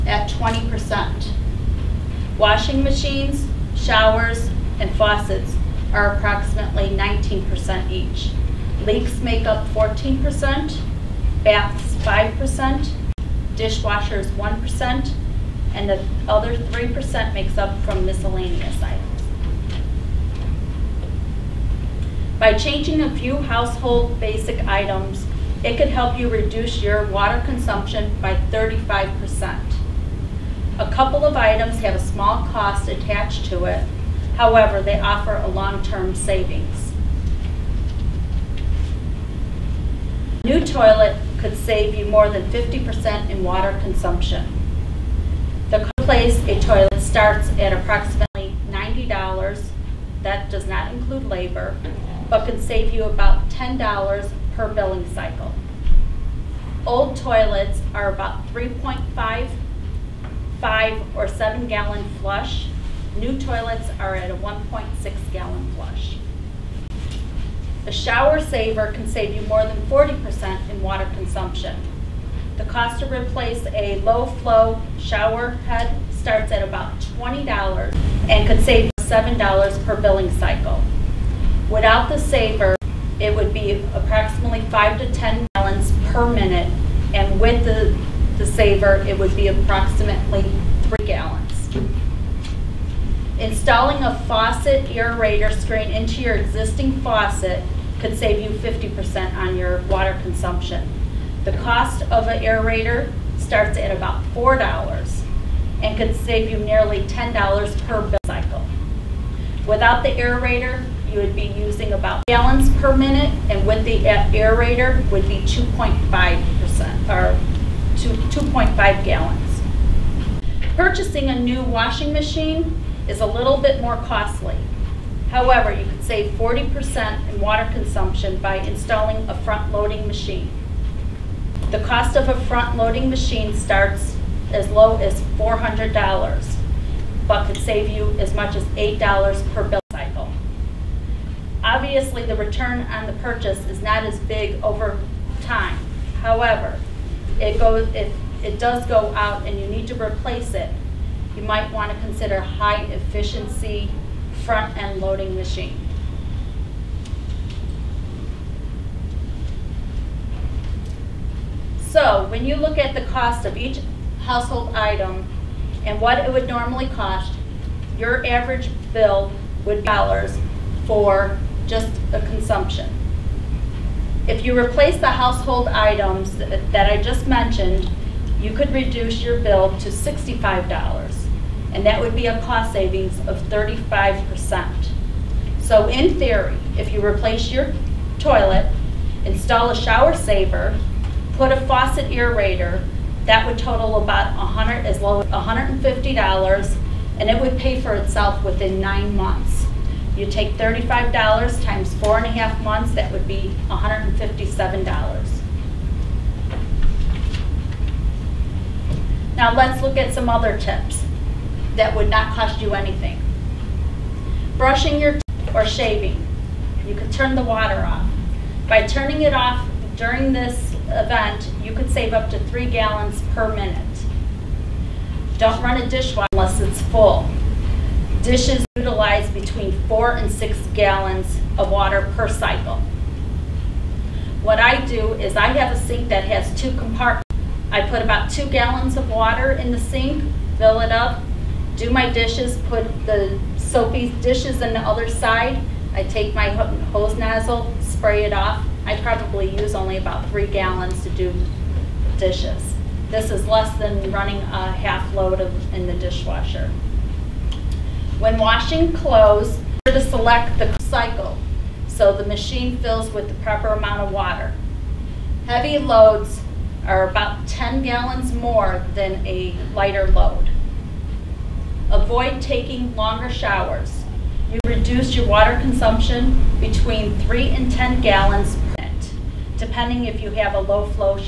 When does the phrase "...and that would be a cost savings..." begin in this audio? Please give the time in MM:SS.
03:01.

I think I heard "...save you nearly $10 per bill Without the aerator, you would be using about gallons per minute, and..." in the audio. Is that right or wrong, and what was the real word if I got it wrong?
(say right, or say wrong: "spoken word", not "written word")
right.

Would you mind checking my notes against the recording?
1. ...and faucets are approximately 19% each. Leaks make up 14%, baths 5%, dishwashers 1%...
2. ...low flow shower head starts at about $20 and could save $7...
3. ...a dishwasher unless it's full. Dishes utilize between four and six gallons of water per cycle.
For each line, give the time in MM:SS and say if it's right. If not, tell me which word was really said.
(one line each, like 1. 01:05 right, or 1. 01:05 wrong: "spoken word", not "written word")
1. 00:04 right
2. 01:14 right
3. 03:45 right.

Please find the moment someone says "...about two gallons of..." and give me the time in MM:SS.
03:58.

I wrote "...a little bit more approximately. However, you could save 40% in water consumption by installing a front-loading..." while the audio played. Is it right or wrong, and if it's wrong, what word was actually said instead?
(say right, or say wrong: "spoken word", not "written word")
wrong: "costly", not "approximately".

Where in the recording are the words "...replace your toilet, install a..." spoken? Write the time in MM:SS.
03:07.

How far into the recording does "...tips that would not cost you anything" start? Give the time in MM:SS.
03:30.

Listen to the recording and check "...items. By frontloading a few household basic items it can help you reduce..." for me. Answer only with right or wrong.
wrong.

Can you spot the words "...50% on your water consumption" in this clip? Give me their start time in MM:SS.
01:38.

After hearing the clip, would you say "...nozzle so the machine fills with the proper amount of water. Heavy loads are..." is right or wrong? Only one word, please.
wrong.